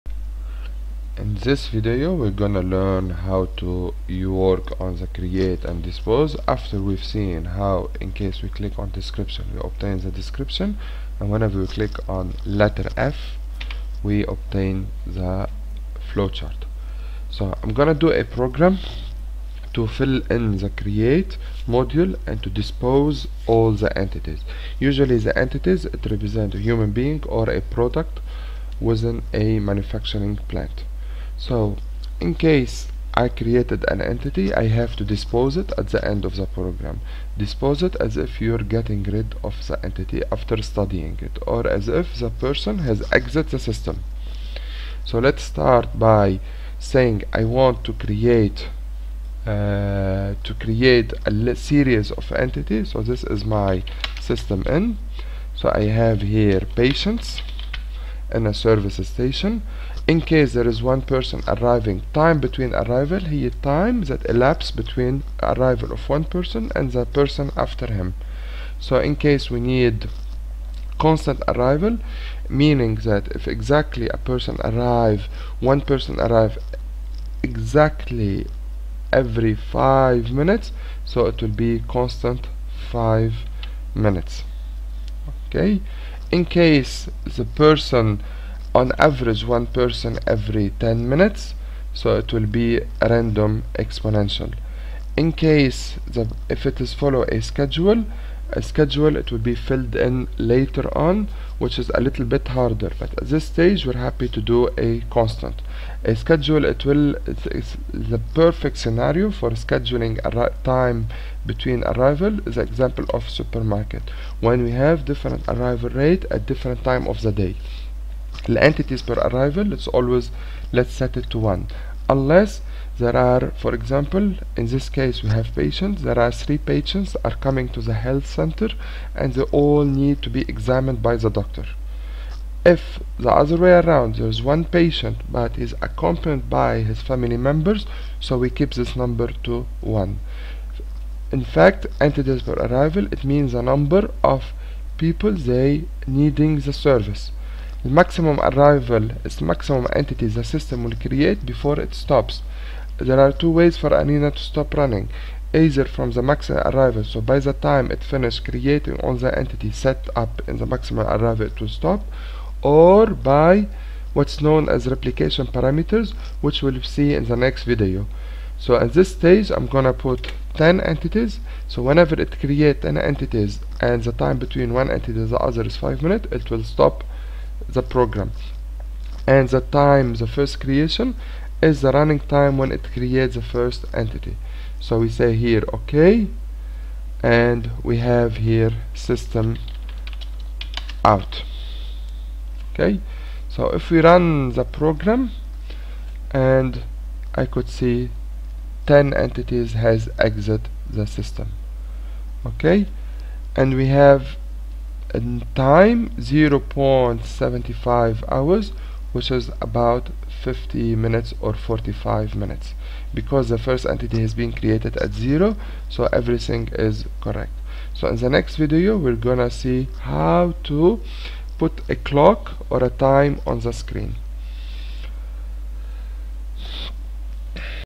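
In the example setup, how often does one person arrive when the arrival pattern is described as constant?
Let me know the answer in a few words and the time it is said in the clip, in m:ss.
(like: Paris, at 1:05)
every 5 minutes, at 1:19.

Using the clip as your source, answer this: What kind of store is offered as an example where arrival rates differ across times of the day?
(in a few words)
supermarket.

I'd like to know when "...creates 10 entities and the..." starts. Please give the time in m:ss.
2:52.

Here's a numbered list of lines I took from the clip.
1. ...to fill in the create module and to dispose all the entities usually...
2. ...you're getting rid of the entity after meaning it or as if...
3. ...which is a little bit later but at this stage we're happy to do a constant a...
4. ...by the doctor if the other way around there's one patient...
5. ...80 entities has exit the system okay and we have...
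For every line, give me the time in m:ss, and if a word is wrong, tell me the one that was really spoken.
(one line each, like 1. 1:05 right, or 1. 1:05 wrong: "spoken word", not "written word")
1. 0:19 right
2. 0:38 wrong: "studying", not "meaning"
3. 1:41 wrong: "harder", not "later"
4. 2:11 right
5. 3:18 wrong: "10", not "80".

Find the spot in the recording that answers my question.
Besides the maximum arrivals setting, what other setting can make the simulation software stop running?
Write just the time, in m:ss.
2:44.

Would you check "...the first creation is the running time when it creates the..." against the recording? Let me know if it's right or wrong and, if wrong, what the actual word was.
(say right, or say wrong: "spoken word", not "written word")
right.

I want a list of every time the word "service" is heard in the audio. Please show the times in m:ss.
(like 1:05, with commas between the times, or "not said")
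0:58, 2:26.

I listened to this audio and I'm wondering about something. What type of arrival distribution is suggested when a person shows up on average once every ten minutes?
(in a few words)
random exponential.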